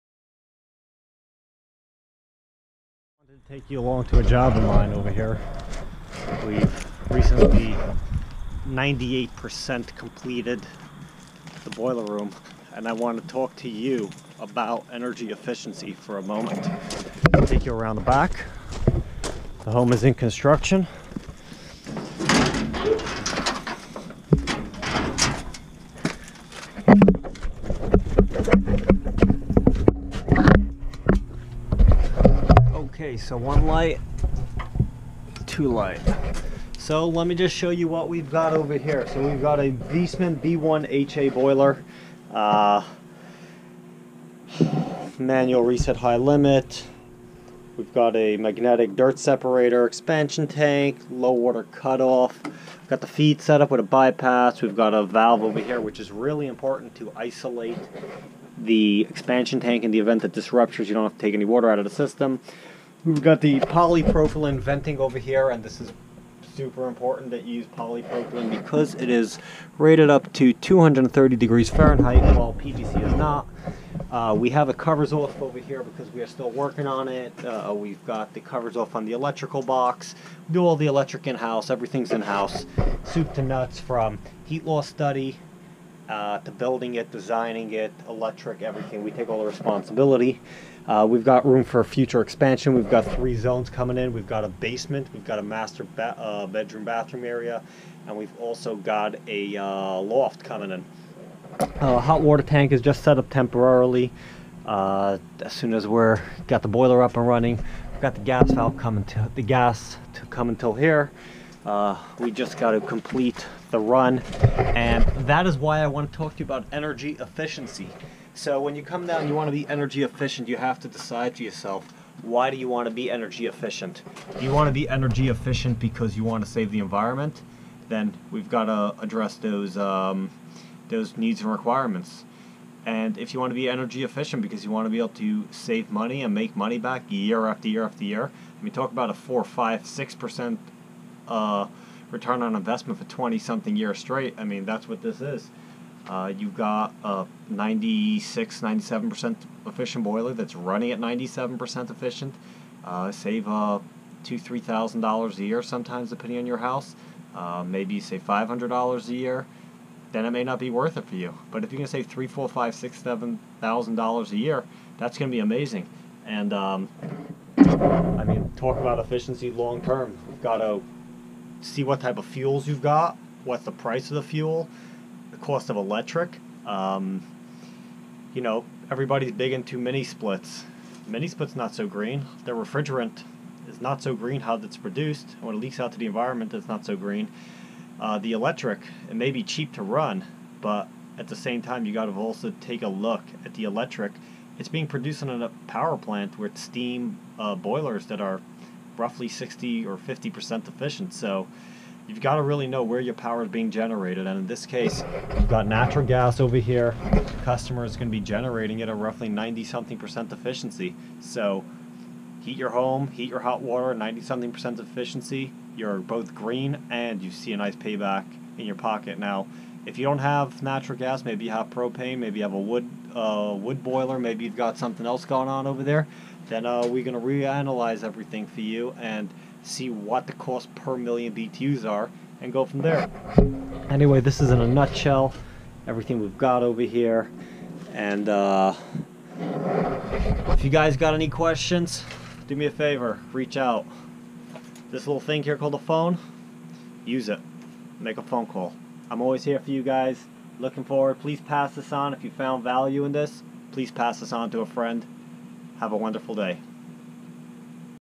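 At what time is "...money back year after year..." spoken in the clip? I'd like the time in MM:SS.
02:16.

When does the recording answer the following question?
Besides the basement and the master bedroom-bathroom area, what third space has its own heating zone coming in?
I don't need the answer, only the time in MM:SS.
01:39.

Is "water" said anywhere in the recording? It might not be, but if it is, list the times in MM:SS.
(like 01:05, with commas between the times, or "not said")
00:51, 01:01, 01:42, 03:33.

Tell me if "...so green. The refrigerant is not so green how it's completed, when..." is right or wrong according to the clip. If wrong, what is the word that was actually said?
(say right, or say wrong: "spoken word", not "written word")
wrong: "produced", not "completed".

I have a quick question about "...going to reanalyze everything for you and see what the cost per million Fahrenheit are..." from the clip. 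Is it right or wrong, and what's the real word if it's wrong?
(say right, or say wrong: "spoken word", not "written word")
wrong: "BTUs", not "Fahrenheit".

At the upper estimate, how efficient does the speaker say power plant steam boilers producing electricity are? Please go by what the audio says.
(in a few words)
60%.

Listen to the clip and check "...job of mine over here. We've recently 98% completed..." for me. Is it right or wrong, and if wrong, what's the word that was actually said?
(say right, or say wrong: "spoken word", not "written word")
right.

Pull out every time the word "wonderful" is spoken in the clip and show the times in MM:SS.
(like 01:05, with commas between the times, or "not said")
04:15.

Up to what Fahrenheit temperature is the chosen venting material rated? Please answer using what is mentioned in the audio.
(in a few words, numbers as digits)
230 degrees.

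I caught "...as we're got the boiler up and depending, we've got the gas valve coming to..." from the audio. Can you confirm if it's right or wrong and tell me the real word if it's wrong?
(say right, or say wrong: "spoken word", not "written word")
wrong: "running", not "depending".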